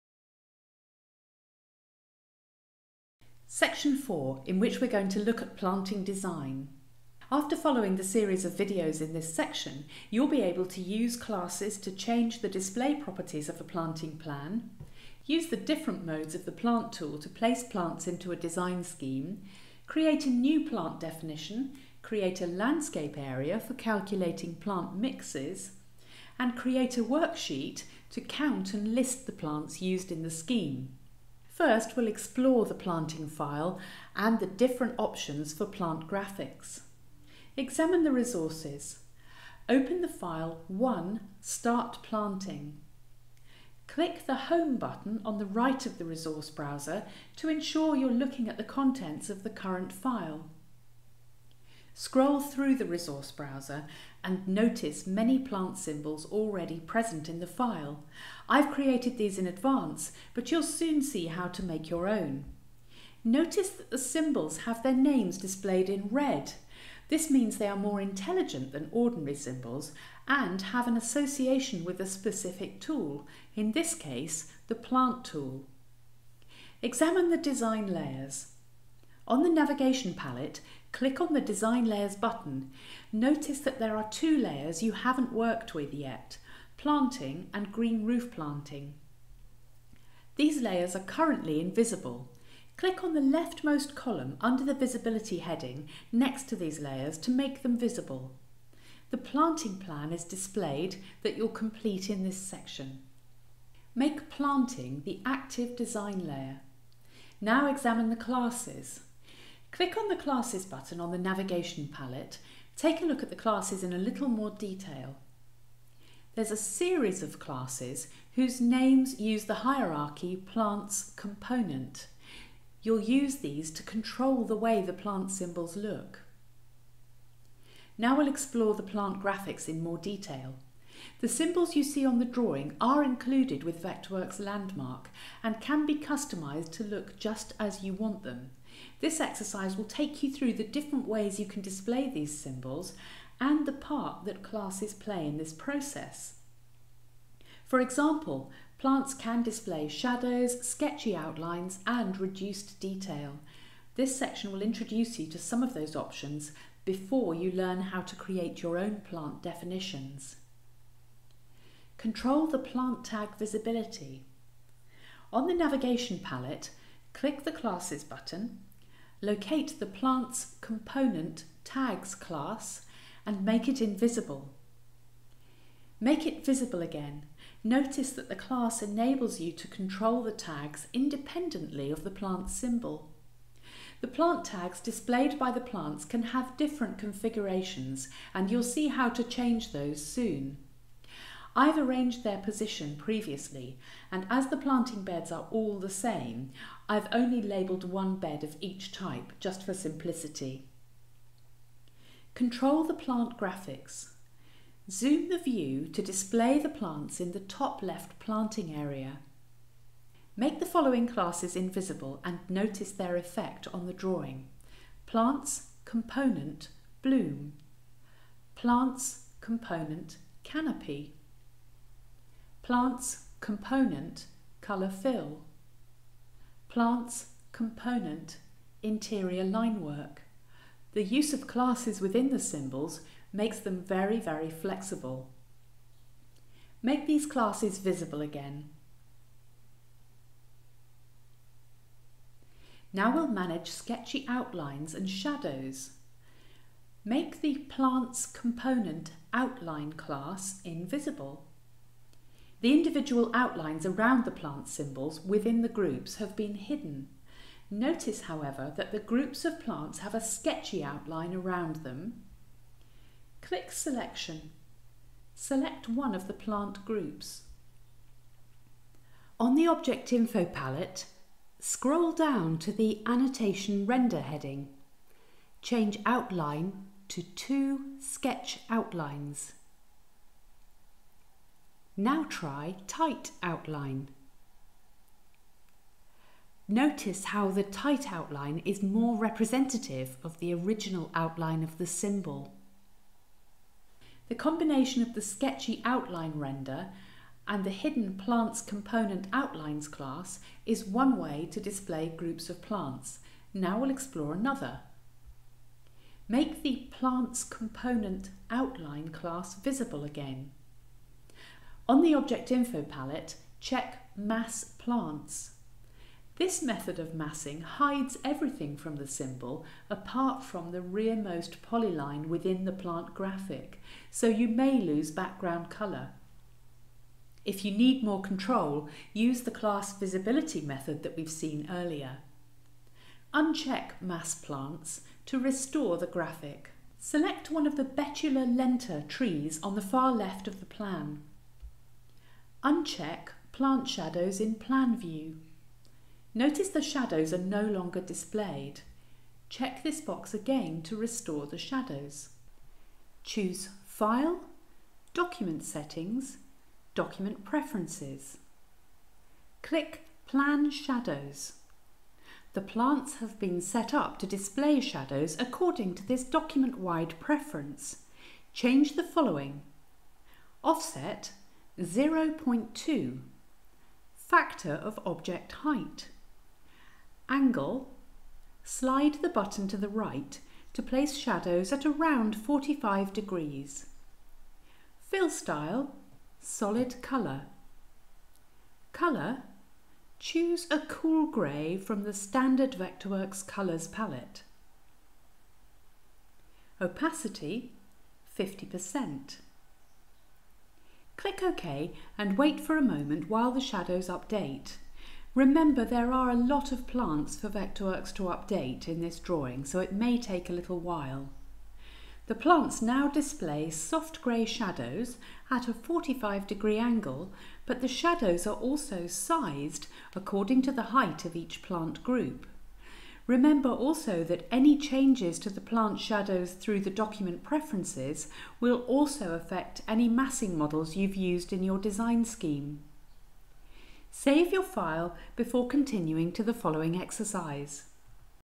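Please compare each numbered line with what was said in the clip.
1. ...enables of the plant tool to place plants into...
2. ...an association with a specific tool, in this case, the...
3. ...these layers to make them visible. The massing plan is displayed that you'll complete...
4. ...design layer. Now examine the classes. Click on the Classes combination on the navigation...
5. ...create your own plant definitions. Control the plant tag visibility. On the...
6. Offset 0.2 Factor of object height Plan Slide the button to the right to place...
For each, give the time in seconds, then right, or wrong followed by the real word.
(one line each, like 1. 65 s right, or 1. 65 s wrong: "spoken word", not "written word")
1. 16 s wrong: "modes", not "enables"
2. 70 s right
3. 96 s wrong: "planting", not "massing"
4. 105 s wrong: "button", not "combination"
5. 158 s right
6. 370 s wrong: "Angle", not "Plan".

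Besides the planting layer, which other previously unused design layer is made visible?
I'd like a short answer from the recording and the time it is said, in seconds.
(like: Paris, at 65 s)
Green roof planting, at 87 s.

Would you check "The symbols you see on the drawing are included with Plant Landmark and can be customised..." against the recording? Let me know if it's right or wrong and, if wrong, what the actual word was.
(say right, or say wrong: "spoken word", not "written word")
wrong: "Vectorworks", not "Plant".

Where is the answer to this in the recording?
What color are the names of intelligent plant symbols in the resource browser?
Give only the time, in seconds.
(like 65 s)
66 s.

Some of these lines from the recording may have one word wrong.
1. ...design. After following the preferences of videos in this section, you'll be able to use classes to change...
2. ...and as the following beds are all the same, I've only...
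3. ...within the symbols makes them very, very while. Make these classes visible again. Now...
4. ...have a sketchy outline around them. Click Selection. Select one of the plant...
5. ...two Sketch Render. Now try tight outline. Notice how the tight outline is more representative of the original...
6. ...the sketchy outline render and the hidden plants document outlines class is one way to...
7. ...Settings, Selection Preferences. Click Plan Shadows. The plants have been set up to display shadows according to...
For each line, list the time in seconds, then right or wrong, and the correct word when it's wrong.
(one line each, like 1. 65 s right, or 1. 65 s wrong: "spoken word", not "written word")
1. 6 s wrong: "series", not "preferences"
2. 194 s wrong: "planting", not "following"
3. 231 s wrong: "flexible", not "while"
4. 259 s right
5. 277 s wrong: "Outlines", not "Render"
6. 295 s wrong: "component", not "document"
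7. 355 s wrong: "Document", not "Selection".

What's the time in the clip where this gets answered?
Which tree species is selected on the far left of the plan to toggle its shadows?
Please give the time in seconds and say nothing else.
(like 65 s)
337 s.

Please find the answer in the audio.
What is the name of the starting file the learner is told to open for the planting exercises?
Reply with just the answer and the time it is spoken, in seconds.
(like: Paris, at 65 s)
1 Start Planting, at 40 s.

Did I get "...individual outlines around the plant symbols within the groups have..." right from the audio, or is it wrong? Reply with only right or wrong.
right.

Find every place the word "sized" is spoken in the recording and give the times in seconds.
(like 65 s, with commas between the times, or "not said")
419 s.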